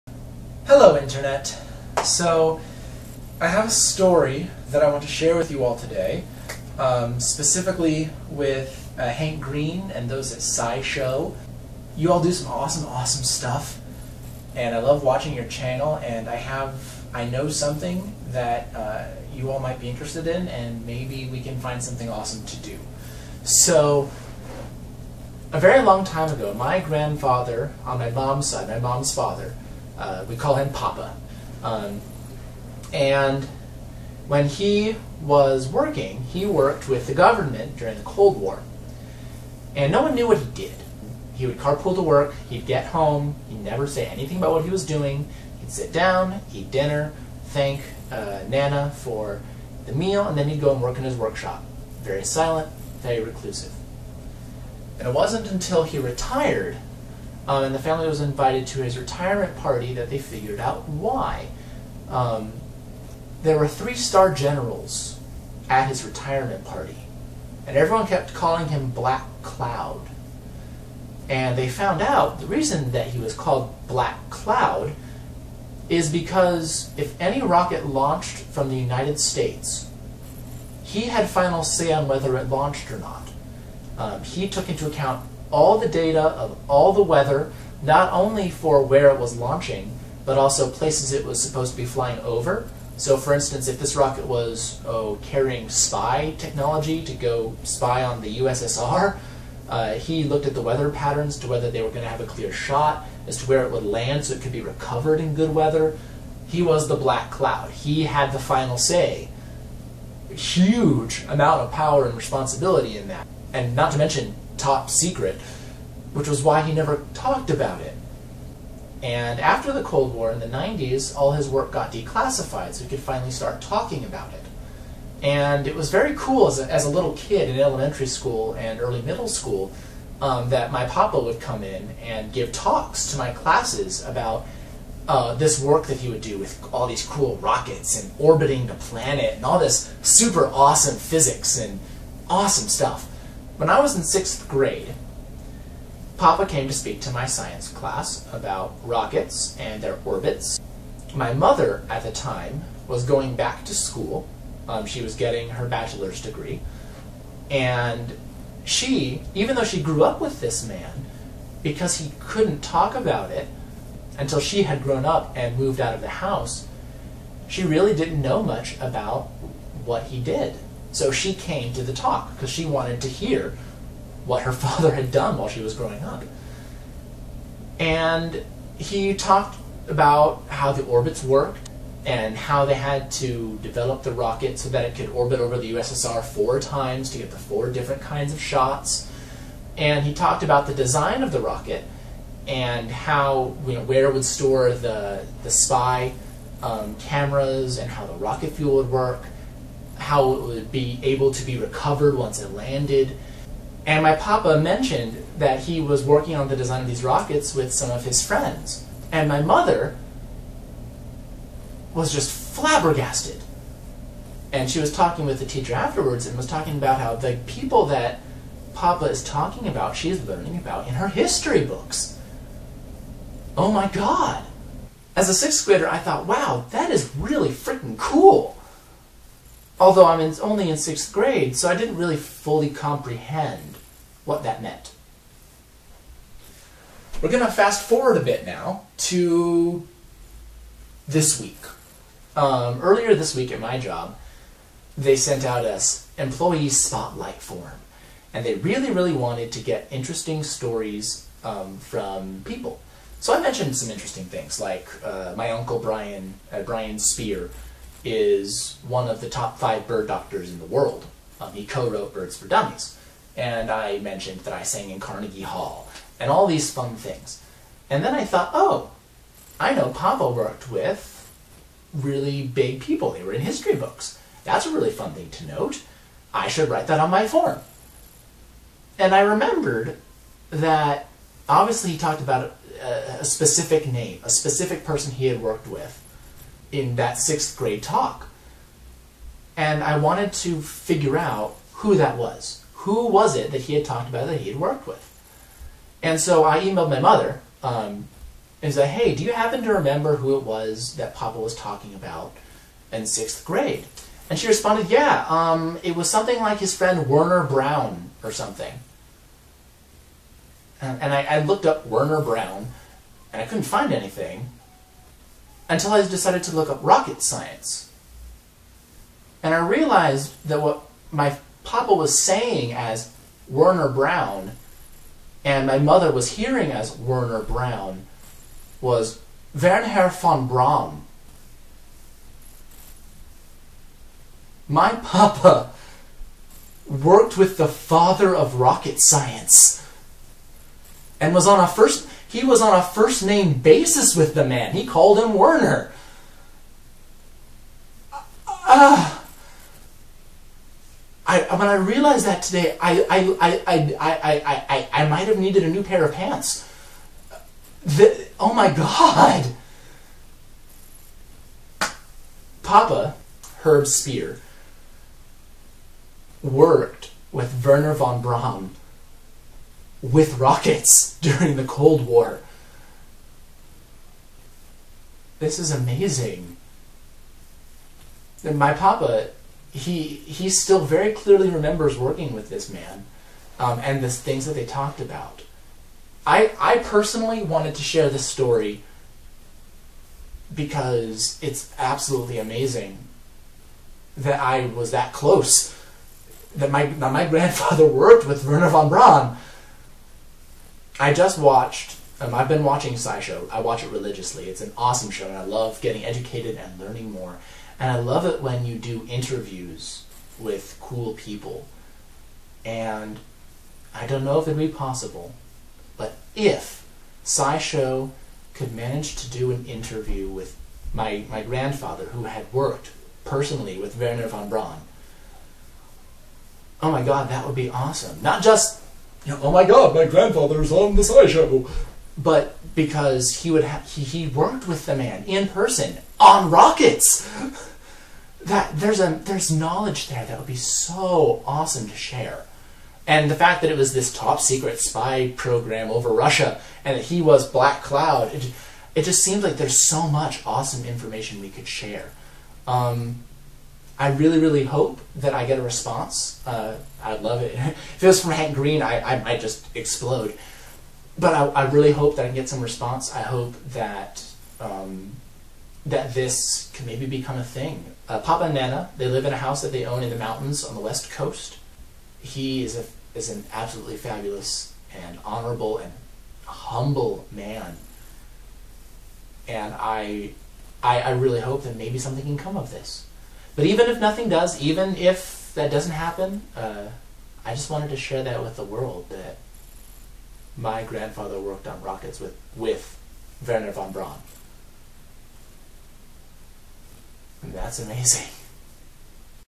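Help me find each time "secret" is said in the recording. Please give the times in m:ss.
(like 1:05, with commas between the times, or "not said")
1:54, 7:24.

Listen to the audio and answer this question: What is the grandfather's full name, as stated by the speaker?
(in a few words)
Herb Spear.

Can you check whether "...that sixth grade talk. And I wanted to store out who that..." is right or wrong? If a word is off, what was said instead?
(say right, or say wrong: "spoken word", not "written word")
wrong: "figure", not "store".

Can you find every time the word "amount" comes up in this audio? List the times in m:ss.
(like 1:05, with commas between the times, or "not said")
1:51.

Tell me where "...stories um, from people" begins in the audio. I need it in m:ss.
4:10.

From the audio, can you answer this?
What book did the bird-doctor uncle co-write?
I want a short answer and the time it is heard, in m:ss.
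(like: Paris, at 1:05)
Birds for Dummies, at 4:22.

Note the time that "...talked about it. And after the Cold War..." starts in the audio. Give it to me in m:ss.
1:57.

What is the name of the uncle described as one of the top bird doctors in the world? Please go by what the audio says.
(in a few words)
Brian Speer.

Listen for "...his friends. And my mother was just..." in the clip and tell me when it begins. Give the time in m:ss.
3:28.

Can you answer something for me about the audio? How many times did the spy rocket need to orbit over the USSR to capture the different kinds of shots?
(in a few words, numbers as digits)
4.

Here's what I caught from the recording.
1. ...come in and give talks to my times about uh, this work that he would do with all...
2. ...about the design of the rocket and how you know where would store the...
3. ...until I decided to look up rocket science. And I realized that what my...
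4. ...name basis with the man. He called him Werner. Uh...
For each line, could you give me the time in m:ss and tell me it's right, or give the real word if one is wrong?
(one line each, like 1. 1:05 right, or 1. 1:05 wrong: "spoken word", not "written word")
1. 2:11 wrong: "classes", not "times"
2. 3:10 right
3. 5:15 right
4. 5:43 right.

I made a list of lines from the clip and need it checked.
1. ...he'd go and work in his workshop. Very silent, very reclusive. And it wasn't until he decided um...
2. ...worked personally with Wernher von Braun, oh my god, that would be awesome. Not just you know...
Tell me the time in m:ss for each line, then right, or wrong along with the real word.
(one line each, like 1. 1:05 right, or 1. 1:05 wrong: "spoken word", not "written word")
1. 0:50 wrong: "retired", not "decided"
2. 7:02 right.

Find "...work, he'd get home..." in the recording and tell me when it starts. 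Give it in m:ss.
0:42.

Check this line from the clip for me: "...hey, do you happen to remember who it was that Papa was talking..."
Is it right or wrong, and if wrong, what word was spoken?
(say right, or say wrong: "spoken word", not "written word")
right.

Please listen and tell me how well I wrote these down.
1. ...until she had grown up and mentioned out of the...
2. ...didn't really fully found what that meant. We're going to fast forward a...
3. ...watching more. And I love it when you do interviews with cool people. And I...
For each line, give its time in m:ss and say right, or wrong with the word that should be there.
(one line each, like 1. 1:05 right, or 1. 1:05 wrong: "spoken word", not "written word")
1. 2:44 wrong: "moved", not "mentioned"
2. 3:51 wrong: "comprehend", not "found"
3. 6:46 wrong: "learning", not "watching".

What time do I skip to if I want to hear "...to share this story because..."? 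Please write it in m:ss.
6:27.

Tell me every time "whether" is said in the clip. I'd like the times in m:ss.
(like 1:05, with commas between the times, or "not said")
1:22, 1:41.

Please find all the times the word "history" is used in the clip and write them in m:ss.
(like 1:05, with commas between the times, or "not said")
3:41, 4:33.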